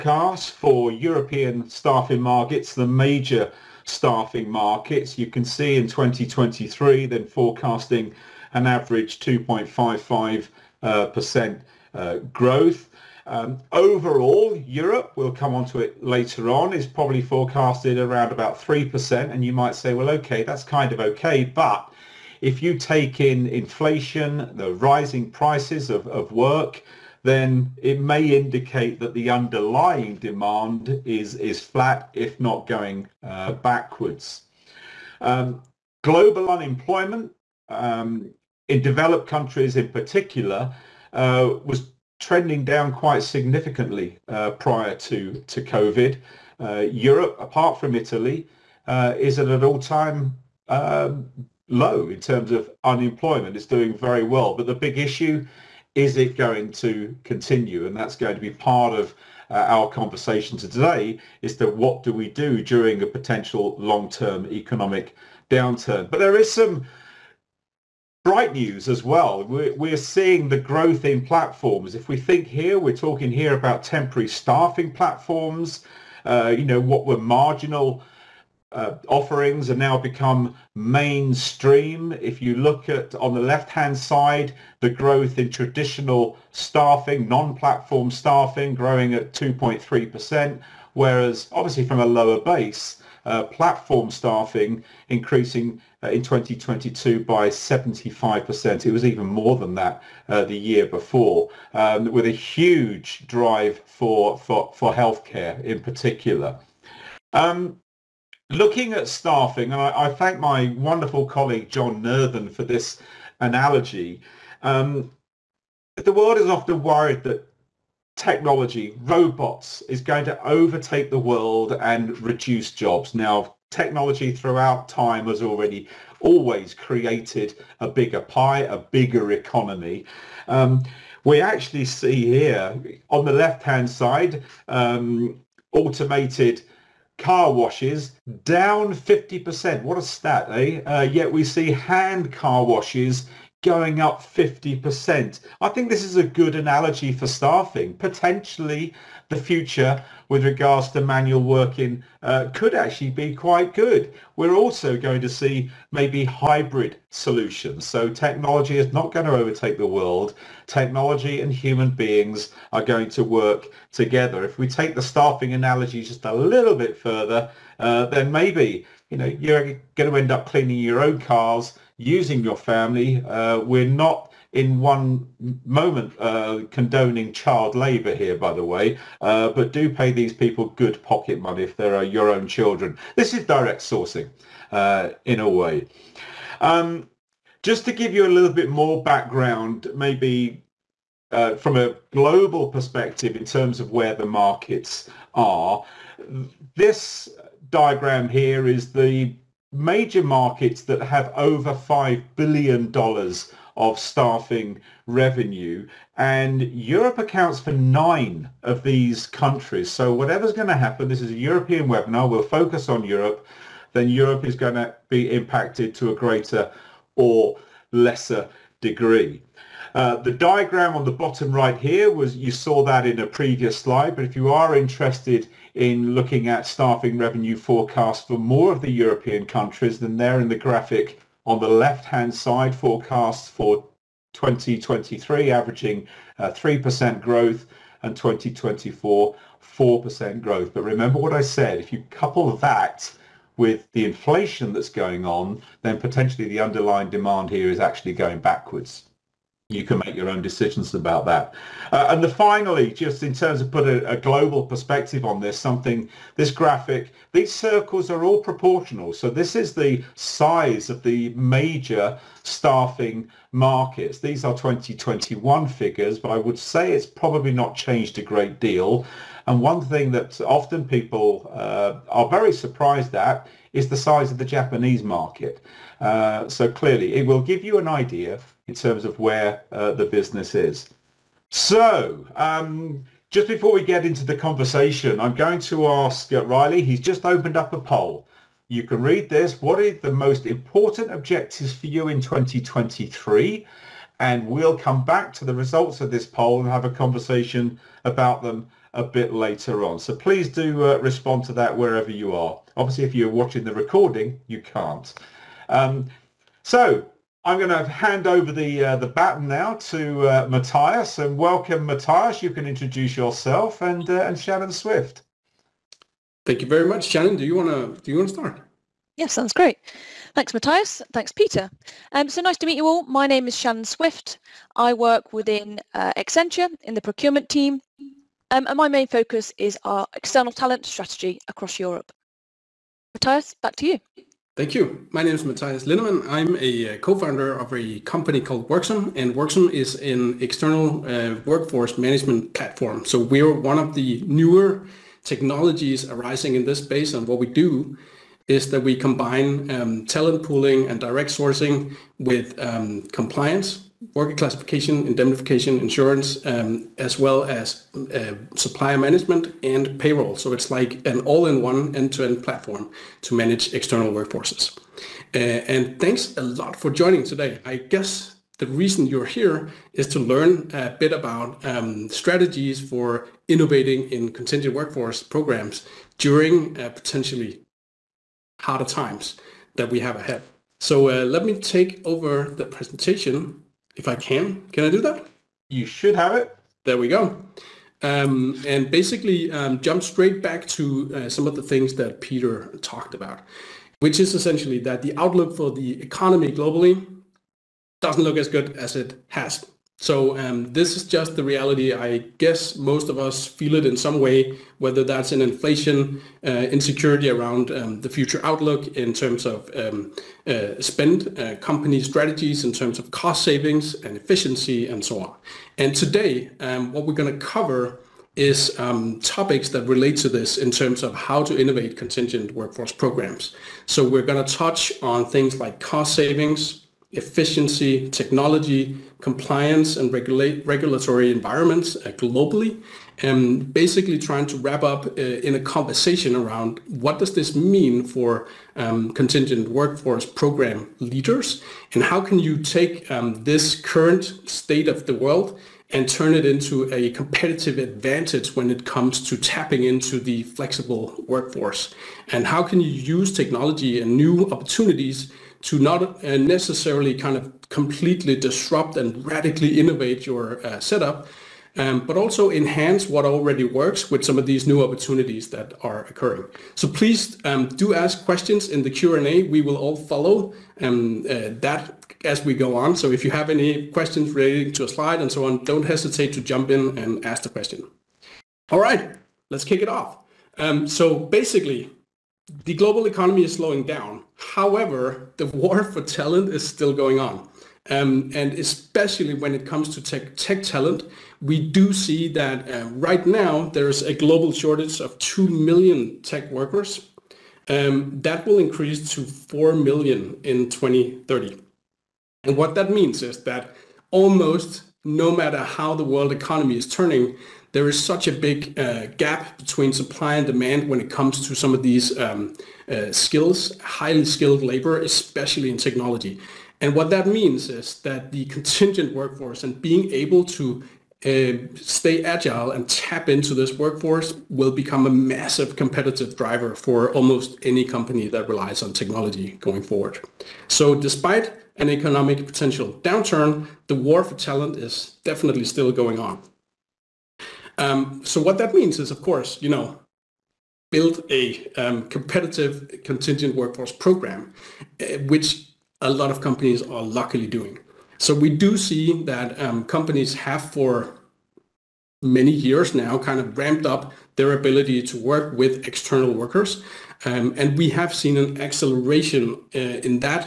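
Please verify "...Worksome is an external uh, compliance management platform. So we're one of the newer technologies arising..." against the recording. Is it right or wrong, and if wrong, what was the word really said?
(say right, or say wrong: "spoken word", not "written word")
wrong: "workforce", not "compliance".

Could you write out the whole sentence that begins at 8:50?
So despite an economic potential downturn, the war for talent is definitely still going on.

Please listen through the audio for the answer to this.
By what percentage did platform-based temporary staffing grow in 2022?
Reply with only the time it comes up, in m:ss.
1:37.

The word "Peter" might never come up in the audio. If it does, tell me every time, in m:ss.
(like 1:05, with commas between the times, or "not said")
5:21, 6:32.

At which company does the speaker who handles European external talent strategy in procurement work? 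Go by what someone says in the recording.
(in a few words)
Accenture.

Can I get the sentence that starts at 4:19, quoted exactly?
So this is the size of the major staffing markets.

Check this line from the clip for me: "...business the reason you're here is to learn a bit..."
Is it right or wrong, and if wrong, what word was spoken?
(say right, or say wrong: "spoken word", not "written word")
wrong: "guess", not "business".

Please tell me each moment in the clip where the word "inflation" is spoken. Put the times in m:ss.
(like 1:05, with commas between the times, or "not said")
0:23, 4:04, 6:45.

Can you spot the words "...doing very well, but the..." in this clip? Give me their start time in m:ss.
0:53.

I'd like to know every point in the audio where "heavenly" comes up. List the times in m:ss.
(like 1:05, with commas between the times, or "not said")
not said.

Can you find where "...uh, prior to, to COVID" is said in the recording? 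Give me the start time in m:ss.
0:44.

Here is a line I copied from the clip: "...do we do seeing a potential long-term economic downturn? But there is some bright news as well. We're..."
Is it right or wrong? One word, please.
wrong.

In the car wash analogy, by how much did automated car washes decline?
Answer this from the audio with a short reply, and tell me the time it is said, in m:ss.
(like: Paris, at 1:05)
50%, at 2:18.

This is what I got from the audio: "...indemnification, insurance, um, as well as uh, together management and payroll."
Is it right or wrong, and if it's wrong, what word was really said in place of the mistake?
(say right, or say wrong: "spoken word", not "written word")
wrong: "supplier", not "together".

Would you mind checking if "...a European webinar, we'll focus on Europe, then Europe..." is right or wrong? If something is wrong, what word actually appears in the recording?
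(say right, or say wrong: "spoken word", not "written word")
right.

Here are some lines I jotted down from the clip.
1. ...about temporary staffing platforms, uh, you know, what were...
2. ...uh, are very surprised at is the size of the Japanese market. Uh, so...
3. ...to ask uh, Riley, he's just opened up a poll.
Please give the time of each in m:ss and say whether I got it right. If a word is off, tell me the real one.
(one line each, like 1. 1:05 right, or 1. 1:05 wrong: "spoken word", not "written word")
1. 1:13 right
2. 4:31 right
3. 4:45 right.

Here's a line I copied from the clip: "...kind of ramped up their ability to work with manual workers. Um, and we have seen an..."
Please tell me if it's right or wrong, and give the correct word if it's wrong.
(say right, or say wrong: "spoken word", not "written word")
wrong: "external", not "manual".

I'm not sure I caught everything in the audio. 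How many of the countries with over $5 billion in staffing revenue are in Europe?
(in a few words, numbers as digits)
9.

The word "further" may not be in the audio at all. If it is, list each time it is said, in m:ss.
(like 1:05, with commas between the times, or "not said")
2:46.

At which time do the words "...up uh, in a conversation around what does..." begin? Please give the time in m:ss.
7:14.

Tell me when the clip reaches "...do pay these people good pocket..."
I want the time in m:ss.
2:59.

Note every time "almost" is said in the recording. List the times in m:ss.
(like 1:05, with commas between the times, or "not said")
8:24, 8:47.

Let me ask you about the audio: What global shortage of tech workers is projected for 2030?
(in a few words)
4 million.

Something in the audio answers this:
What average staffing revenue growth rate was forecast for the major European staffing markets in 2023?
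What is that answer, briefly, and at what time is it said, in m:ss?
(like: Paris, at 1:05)
2.55%, at 0:09.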